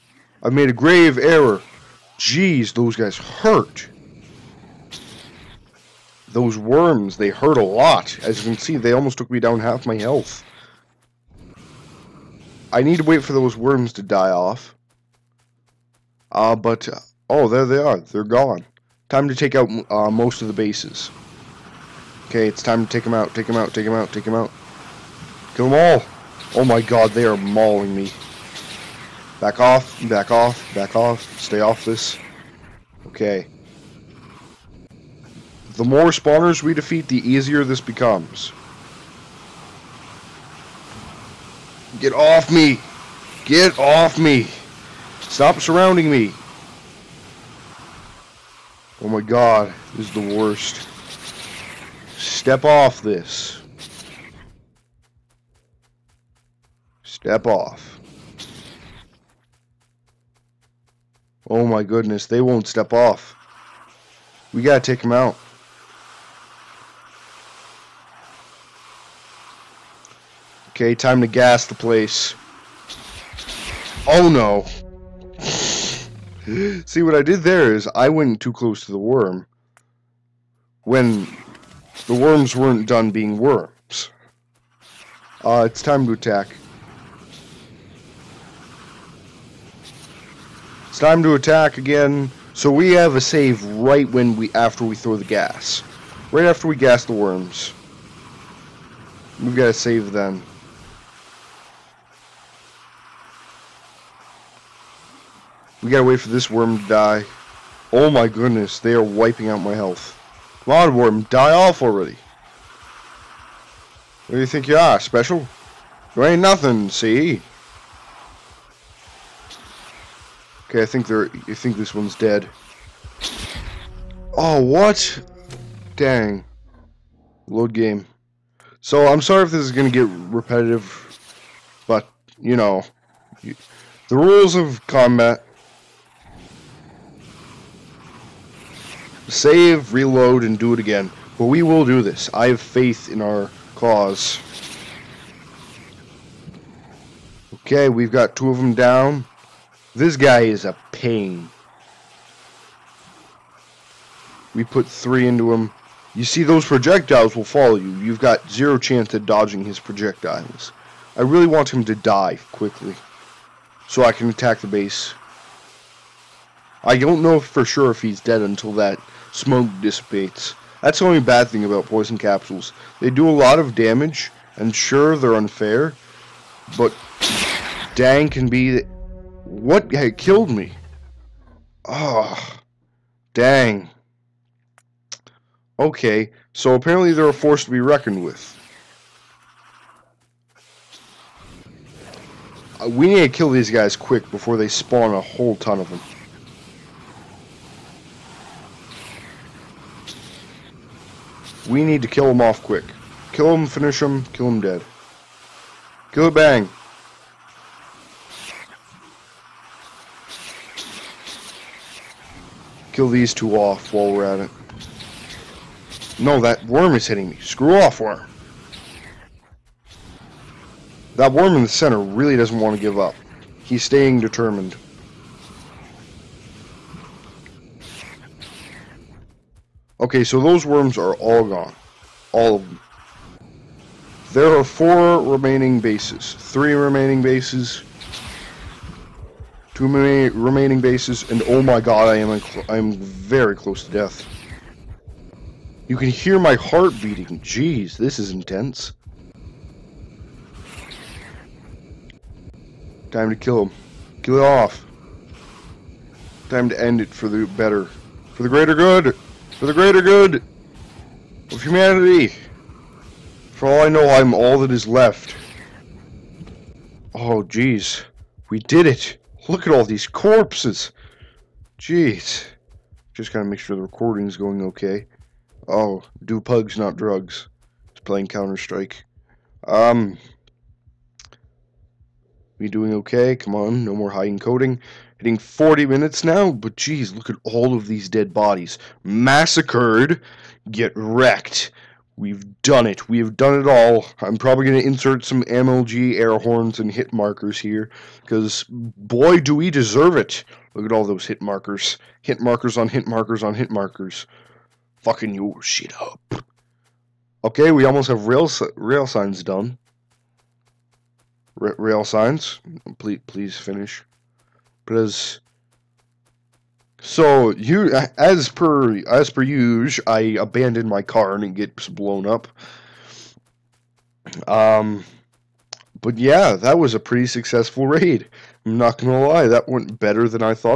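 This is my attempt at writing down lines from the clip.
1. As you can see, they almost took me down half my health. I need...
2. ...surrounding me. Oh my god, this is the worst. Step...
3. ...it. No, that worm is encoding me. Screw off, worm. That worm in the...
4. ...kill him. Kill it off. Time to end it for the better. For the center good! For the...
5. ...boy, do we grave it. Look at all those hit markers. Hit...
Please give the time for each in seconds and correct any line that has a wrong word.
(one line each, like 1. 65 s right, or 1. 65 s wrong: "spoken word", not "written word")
1. 8 s right
2. 45 s right
3. 214 s wrong: "hitting", not "encoding"
4. 253 s wrong: "greater", not "center"
5. 298 s wrong: "deserve", not "grave".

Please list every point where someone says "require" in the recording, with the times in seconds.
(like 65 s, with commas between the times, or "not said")
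not said.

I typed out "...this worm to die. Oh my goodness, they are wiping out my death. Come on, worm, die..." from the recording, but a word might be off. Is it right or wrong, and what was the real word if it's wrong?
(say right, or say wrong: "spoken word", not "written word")
wrong: "health", not "death".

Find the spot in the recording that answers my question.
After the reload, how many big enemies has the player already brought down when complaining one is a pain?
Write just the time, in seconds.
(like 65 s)
148 s.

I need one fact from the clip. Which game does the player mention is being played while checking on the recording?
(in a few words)
Counter-Strike.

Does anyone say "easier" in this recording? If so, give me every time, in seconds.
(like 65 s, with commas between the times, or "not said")
37 s.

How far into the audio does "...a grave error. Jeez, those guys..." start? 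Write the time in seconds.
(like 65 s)
0 s.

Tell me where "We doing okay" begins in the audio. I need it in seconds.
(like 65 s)
282 s.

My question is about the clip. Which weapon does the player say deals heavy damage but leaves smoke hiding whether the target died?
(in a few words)
Poison capsules.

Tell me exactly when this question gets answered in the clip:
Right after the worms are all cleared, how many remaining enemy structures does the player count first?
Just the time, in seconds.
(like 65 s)
234 s.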